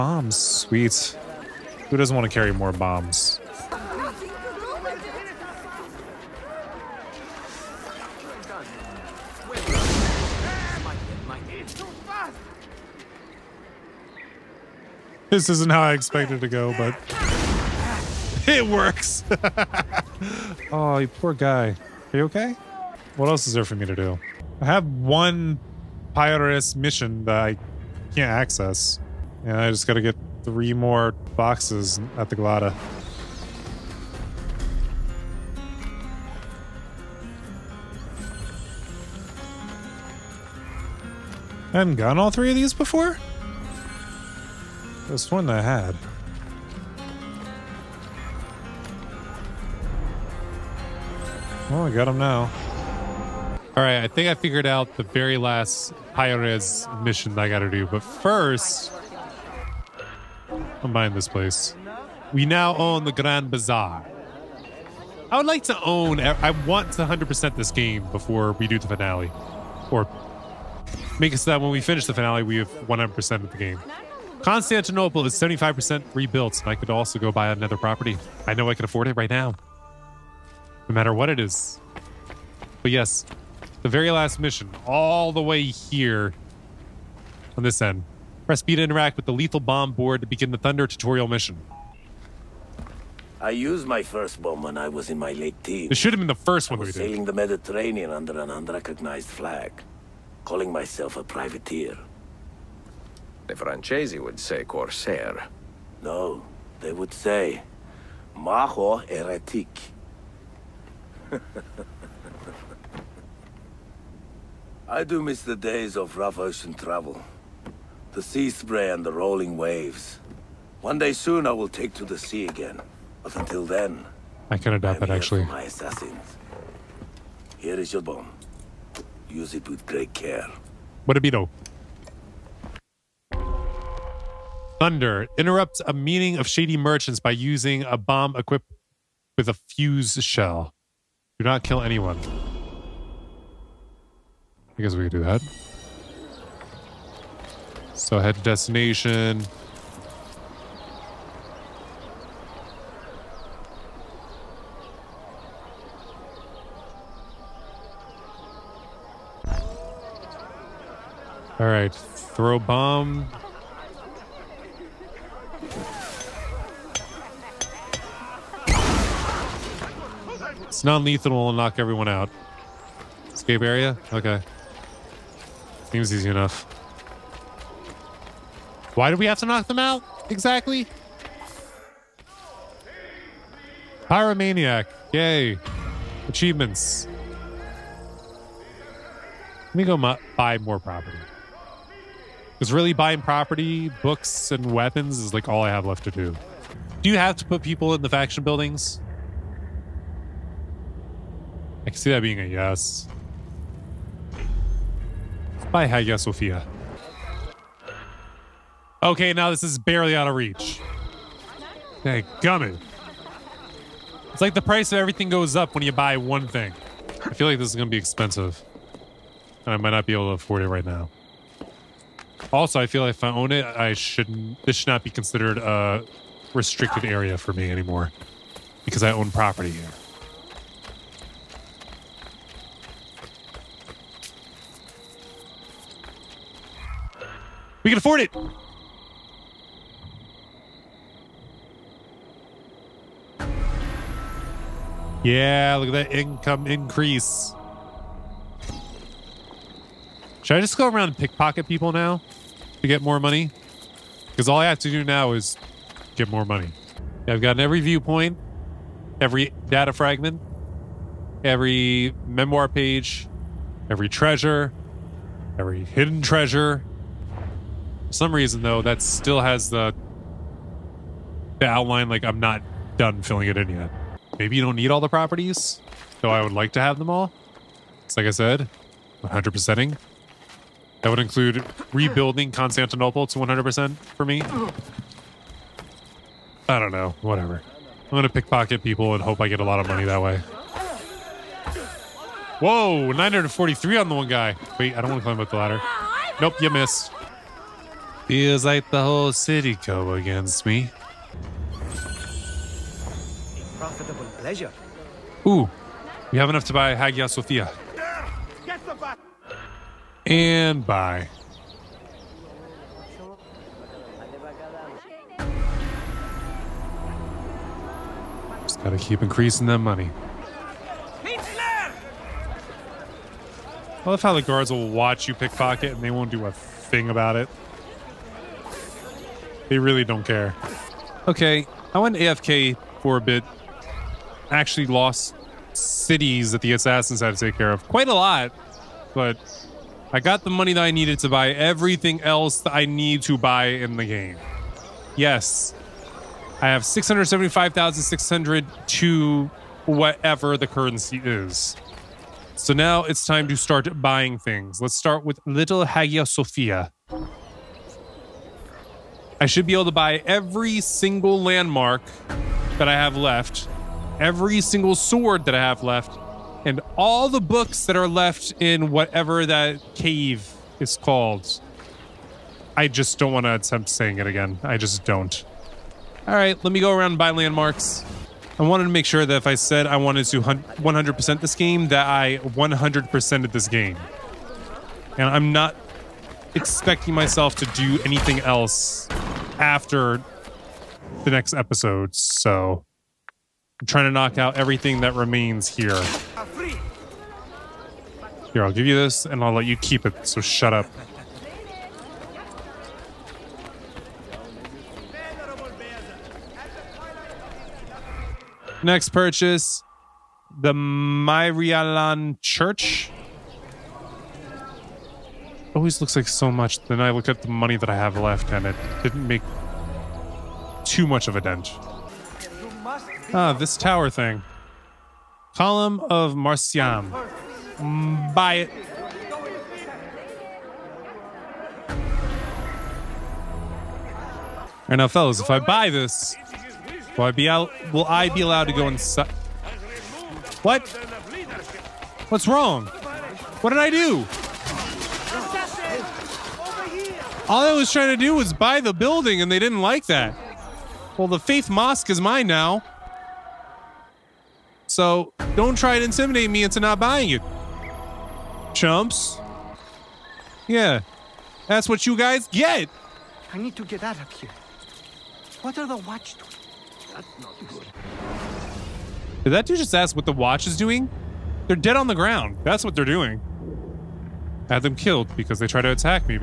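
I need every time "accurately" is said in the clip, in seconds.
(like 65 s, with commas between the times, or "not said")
not said.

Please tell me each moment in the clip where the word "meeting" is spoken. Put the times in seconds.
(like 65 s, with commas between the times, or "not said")
135 s.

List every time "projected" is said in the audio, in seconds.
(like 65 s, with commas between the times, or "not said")
not said.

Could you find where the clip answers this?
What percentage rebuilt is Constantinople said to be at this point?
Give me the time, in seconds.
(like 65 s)
75 s.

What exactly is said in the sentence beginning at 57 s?
But first, I'm buying this place.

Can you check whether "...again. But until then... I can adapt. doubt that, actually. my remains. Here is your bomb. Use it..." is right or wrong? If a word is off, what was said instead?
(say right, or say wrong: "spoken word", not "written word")
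wrong: "assassins", not "remains".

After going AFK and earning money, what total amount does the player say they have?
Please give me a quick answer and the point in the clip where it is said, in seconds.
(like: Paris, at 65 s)
675,600, at 346 s.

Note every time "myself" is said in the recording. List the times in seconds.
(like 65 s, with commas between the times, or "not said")
100 s, 387 s.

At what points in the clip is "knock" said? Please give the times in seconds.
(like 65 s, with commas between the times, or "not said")
171 s, 179 s, 394 s.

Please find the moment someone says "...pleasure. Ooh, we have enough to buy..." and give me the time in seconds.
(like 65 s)
304 s.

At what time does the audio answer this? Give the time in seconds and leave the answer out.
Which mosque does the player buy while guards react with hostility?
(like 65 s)
451 s.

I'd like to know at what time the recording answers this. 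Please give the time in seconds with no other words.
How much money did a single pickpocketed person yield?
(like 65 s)
293 s.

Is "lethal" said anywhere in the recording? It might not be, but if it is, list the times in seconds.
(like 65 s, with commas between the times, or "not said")
89 s, 170 s.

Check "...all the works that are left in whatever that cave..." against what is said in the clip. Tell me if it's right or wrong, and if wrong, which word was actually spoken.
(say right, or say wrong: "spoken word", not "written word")
wrong: "books", not "works".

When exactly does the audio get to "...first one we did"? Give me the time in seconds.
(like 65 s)
96 s.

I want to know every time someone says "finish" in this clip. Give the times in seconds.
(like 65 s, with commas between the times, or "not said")
71 s.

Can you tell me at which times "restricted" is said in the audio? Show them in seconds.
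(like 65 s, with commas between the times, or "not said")
226 s.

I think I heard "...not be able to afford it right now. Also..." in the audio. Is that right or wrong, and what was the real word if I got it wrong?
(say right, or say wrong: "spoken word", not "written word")
right.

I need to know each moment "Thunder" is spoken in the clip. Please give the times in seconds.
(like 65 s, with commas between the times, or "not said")
90 s, 134 s.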